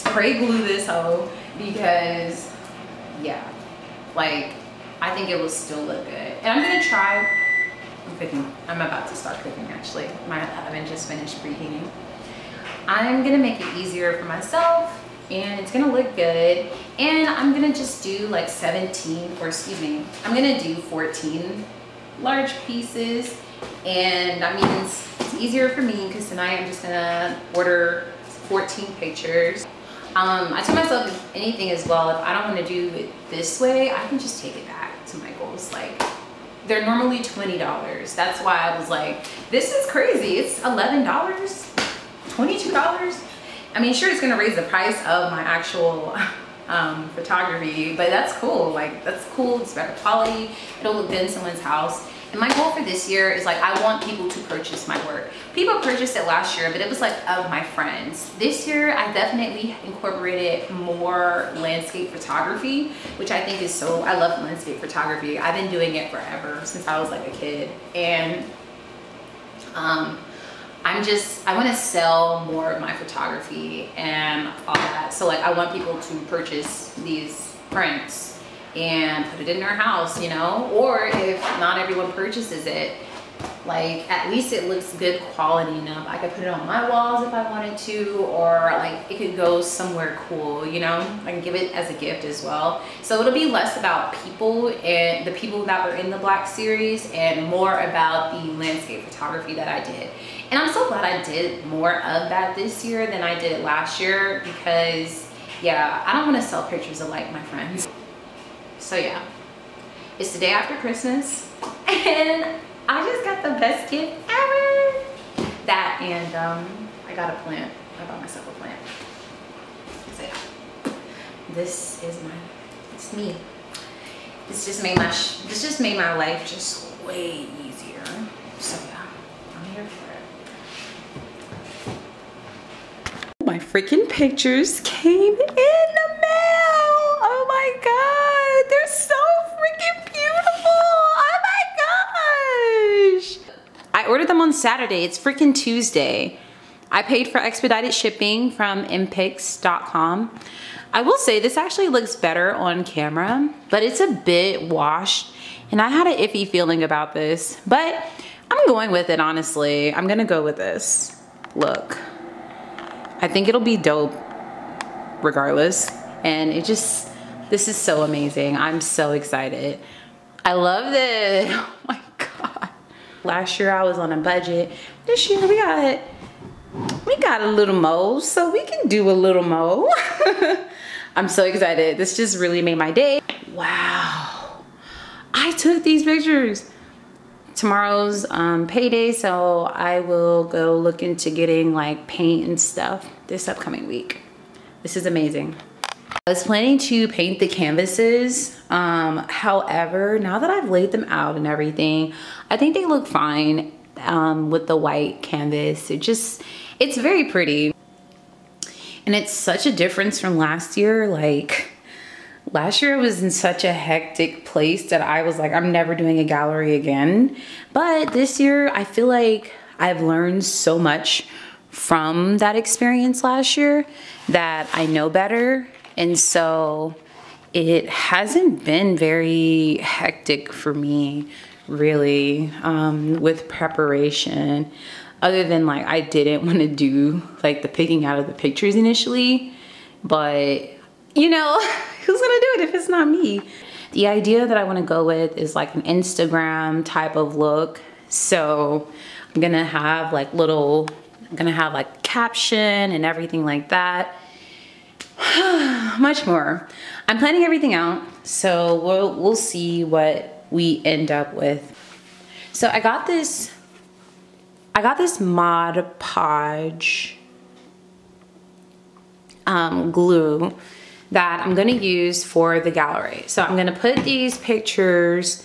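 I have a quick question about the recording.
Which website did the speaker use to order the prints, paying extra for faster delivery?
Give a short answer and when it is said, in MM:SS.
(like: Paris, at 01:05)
mpix.com, at 02:28.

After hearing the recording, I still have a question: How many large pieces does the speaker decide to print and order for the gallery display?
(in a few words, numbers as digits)
14.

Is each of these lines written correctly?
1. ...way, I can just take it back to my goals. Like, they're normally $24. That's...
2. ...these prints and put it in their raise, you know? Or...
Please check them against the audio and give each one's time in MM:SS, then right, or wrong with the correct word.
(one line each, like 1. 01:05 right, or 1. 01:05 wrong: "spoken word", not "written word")
1. 00:33 wrong: "20", not "24"
2. 01:16 wrong: "house", not "raise".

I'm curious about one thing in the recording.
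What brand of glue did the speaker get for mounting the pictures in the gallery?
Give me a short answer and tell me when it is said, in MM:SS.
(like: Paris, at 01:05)
Mod Podge, at 04:25.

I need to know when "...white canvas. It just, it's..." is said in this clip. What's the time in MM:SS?
03:24.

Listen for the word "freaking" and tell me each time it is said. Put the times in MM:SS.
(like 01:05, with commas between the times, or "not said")
02:13, 02:25.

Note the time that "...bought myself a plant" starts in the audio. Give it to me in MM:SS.
01:58.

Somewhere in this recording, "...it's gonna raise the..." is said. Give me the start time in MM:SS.
00:44.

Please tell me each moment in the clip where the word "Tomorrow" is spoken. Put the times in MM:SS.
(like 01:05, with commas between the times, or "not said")
03:07.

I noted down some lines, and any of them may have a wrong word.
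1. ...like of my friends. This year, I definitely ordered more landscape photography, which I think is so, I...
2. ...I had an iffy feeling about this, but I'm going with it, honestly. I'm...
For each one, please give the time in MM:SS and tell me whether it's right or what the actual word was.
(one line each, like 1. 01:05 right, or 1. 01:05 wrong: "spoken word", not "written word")
1. 00:56 wrong: "incorporated", not "ordered"
2. 02:35 right.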